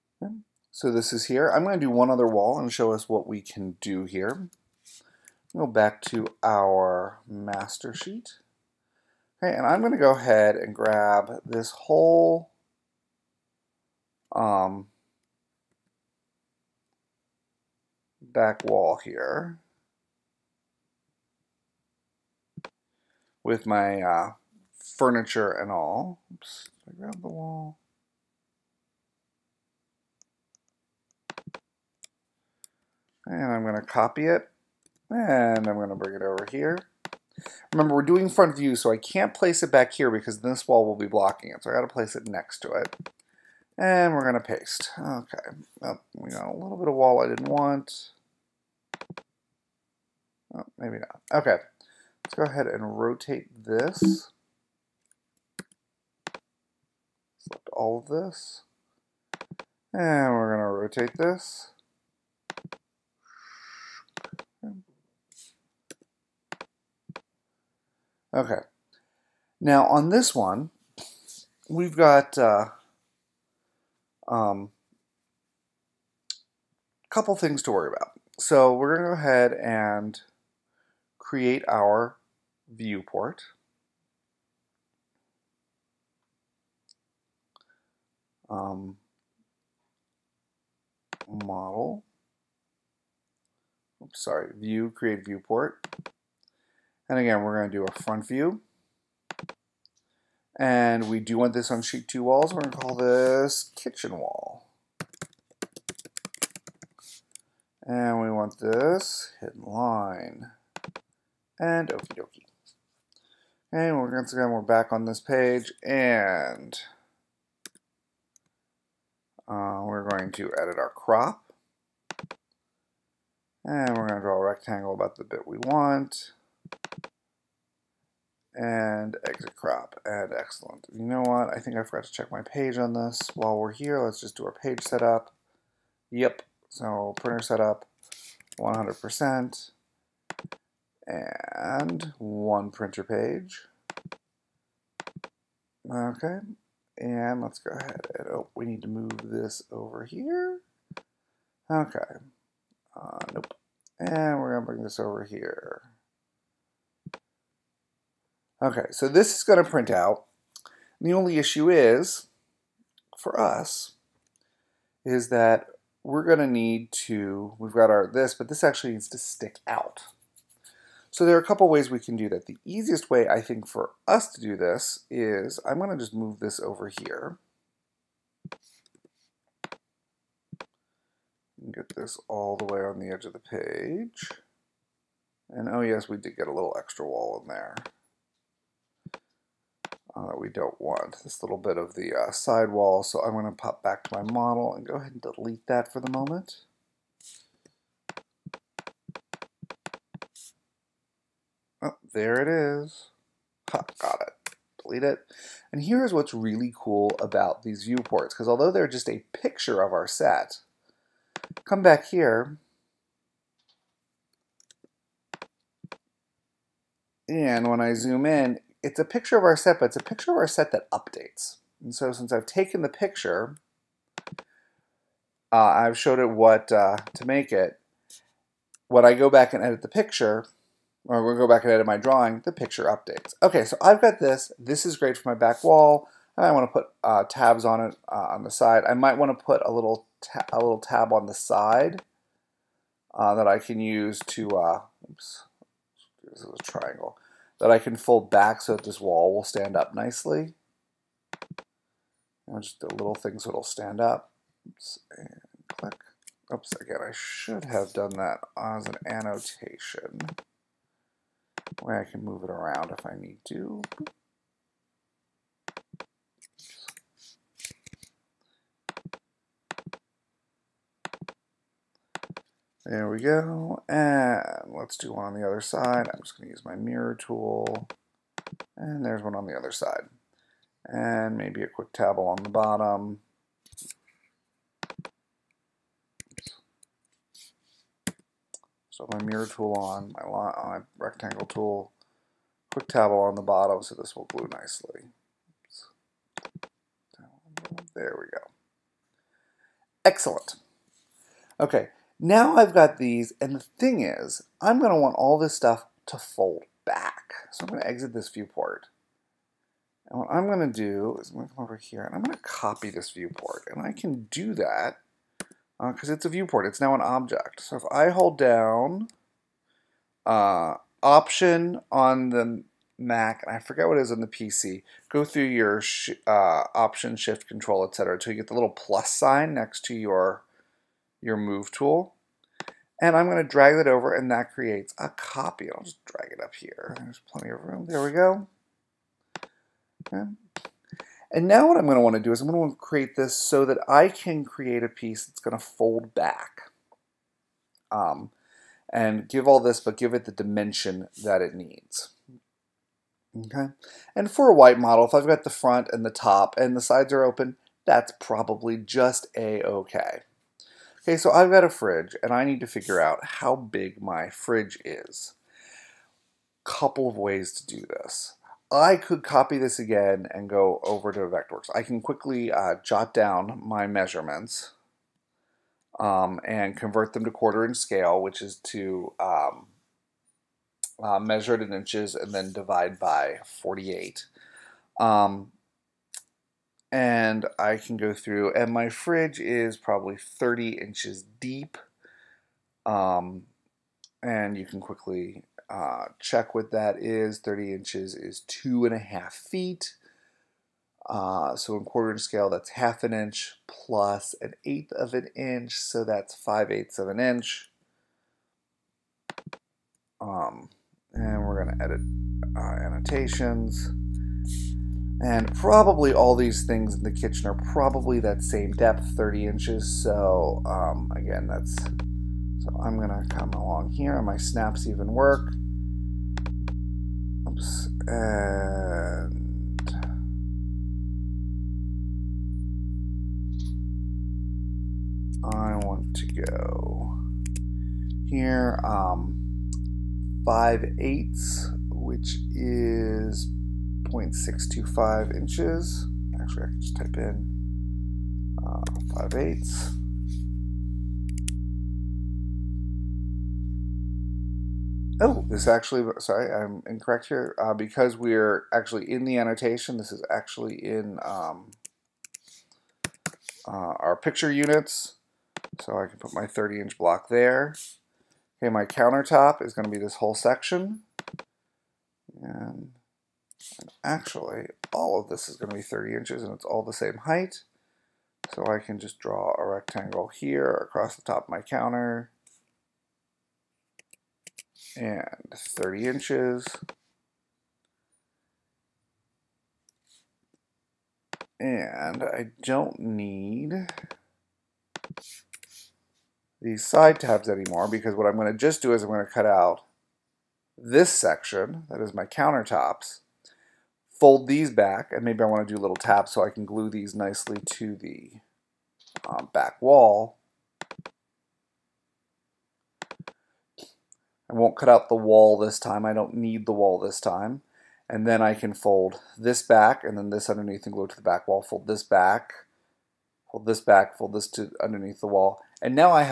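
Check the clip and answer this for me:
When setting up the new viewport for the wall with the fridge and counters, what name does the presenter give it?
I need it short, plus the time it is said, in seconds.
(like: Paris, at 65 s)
kitchen wall, at 103 s.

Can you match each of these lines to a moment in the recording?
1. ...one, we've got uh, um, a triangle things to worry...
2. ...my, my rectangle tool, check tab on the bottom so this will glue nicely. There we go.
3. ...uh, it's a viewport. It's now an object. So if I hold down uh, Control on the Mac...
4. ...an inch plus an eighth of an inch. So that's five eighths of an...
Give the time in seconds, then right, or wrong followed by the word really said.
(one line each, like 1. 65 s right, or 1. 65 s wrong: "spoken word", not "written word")
1. 70 s wrong: "couple", not "triangle"
2. 290 s wrong: "quick", not "check"
3. 316 s wrong: "Option", not "Control"
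4. 403 s right.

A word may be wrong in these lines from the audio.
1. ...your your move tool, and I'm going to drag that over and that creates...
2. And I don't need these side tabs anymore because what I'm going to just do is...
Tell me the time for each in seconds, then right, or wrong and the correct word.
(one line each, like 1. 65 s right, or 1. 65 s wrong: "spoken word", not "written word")
1. 329 s right
2. 491 s right.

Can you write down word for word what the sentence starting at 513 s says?
I won't cut out the wall this time.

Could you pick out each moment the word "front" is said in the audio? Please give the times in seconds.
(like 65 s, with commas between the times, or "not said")
38 s, 98 s, 355 s.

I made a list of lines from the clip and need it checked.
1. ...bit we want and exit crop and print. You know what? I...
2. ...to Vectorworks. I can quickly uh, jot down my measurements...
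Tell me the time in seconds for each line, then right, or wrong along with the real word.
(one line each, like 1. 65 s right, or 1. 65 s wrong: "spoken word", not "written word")
1. 125 s wrong: "excellent", not "print"
2. 371 s right.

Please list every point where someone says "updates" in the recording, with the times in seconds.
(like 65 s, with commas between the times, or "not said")
220 s, 232 s.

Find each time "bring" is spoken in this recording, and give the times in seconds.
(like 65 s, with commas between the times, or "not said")
35 s, 154 s.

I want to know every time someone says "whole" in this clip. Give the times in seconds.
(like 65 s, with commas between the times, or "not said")
11 s, 470 s.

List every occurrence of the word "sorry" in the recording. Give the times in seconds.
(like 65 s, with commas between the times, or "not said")
94 s, 456 s.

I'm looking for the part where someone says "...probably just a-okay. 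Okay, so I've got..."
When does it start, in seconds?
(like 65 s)
358 s.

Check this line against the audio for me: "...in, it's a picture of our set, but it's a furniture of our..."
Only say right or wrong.
wrong.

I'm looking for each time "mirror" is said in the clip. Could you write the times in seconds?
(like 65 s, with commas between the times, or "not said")
276 s, 289 s.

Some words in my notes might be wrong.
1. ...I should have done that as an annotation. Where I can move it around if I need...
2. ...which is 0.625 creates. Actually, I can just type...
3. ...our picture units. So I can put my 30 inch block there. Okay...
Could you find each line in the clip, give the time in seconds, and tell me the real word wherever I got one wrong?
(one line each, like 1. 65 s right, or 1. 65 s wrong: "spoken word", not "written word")
1. 257 s right
2. 441 s wrong: "inches", not "creates"
3. 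463 s right.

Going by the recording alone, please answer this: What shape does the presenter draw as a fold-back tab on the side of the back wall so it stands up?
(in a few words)
triangle.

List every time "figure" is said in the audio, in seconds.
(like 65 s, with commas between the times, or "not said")
362 s.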